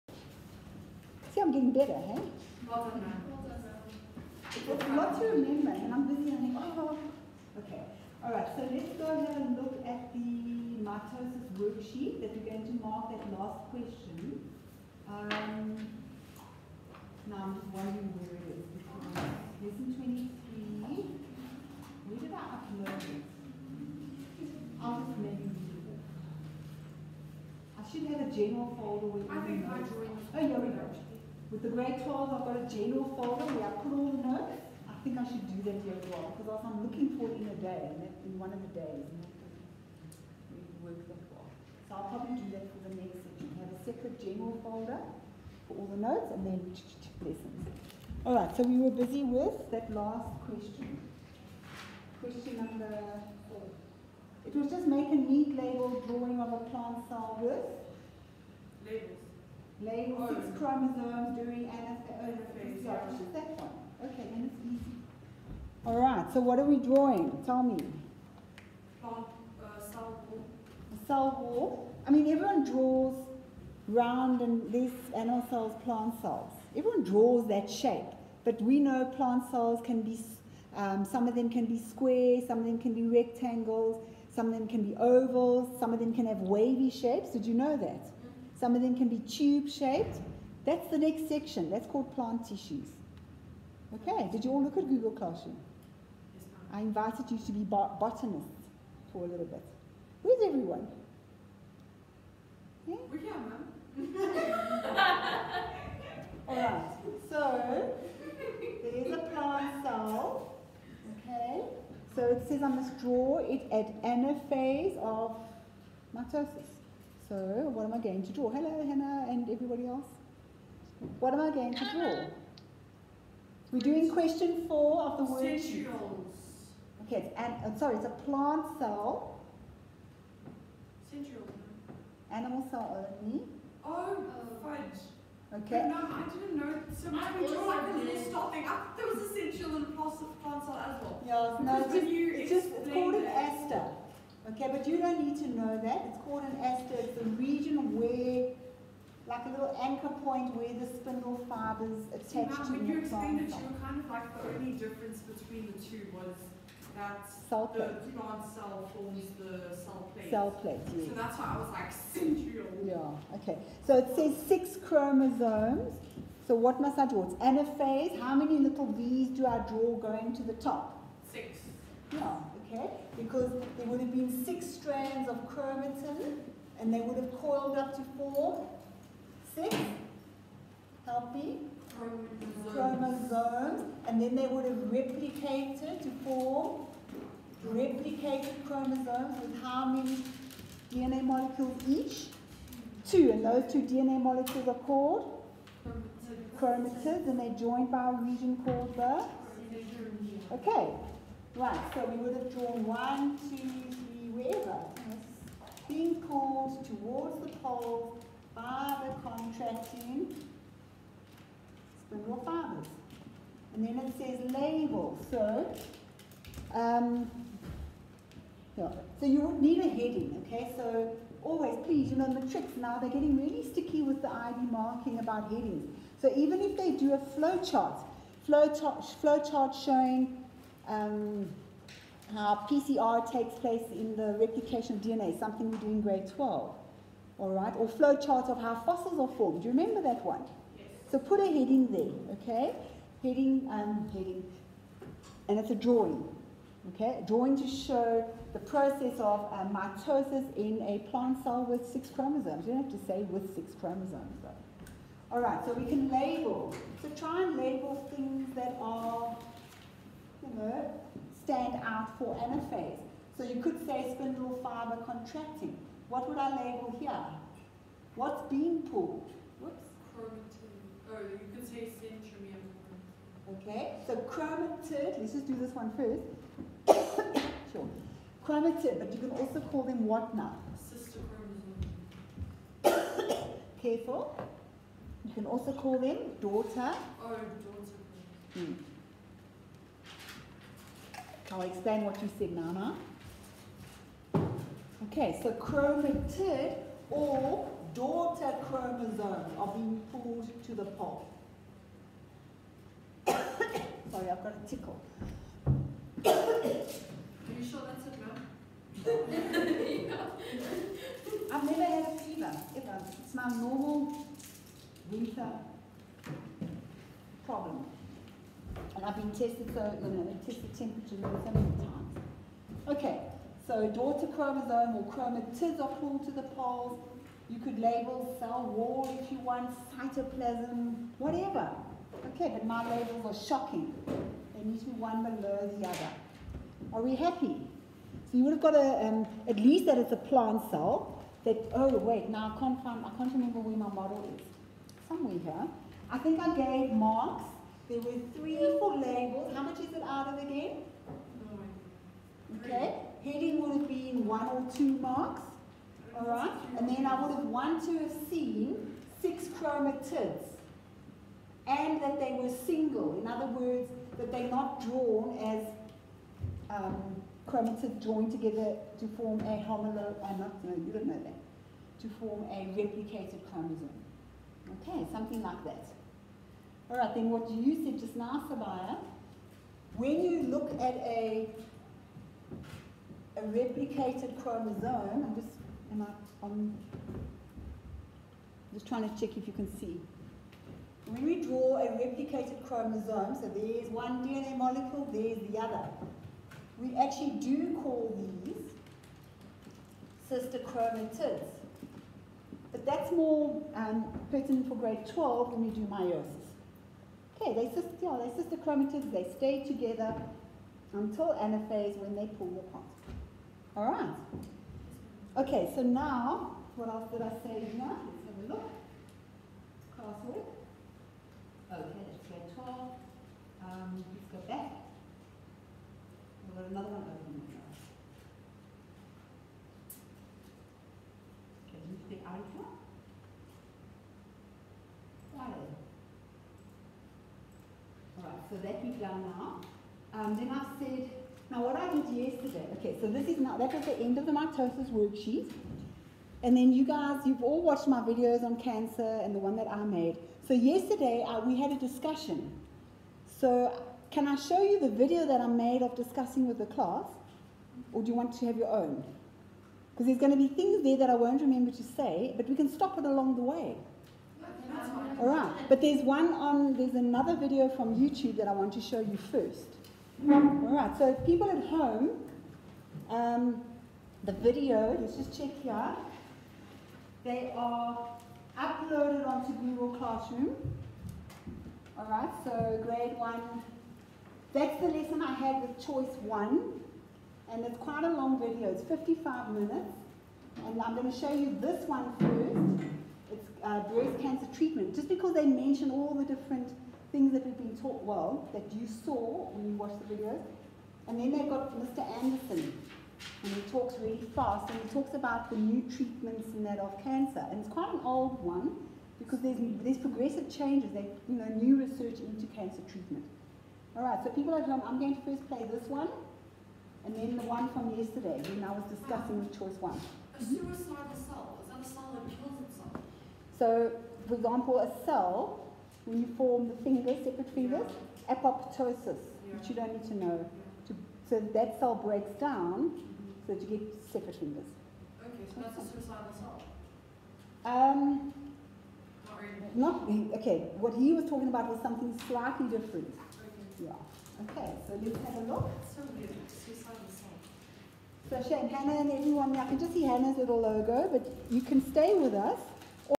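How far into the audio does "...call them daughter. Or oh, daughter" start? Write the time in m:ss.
4:45.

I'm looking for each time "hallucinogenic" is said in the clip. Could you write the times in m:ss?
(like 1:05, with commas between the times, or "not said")
not said.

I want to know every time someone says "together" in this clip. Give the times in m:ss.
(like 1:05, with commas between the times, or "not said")
6:08, 6:49.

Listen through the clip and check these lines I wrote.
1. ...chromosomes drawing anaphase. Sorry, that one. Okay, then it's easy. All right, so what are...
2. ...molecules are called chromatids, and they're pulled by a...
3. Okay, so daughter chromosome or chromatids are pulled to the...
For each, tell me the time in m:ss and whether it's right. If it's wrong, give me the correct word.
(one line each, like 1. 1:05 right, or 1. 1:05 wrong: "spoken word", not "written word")
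1. 1:00 wrong: "during", not "drawing"
2. 3:14 wrong: "joined", not "pulled"
3. 5:22 right.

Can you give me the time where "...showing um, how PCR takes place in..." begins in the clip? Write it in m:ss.
3:49.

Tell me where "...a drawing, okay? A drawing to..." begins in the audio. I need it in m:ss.
4:05.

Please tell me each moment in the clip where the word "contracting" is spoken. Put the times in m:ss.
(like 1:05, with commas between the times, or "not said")
3:29, 4:25.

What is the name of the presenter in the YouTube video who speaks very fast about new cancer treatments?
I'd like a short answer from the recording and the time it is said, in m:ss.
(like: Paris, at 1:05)
Mr. Anderson, at 8:21.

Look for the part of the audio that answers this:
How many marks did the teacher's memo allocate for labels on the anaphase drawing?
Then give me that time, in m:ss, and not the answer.
5:48.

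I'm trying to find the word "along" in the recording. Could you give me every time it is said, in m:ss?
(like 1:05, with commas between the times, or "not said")
7:43.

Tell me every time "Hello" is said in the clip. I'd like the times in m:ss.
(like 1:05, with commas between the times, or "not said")
1:58.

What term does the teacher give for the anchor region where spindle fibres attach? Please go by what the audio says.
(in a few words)
aster.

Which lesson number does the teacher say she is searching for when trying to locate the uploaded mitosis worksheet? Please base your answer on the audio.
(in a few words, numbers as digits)
Lesson 23.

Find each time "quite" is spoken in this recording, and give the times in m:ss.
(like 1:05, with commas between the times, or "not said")
8:07, 8:27.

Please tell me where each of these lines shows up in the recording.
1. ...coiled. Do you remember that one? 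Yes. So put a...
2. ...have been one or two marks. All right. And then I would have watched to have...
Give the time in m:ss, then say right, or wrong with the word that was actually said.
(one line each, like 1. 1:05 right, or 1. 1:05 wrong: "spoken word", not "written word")
1. 3:59 wrong: "formed", not "coiled"
2. 5:53 wrong: "wanted", not "watched".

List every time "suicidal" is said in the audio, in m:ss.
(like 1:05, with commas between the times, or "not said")
8:55, 9:06.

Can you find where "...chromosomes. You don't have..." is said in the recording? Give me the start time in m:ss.
4:12.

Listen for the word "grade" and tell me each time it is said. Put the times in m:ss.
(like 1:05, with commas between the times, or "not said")
0:31, 3:56, 6:44, 7:02, 8:02.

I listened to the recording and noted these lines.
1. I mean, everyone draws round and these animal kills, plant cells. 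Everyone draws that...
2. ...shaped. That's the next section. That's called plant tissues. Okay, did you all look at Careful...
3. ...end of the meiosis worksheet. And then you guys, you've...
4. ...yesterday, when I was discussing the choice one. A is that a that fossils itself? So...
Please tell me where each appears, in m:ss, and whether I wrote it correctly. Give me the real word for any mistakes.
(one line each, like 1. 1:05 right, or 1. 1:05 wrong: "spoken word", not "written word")
1. 1:12 wrong: "cells", not "kills"
2. 1:29 wrong: "Google", not "Careful"
3. 7:23 wrong: "mitosis", not "meiosis"
4. 8:37 wrong: "kills", not "fossils".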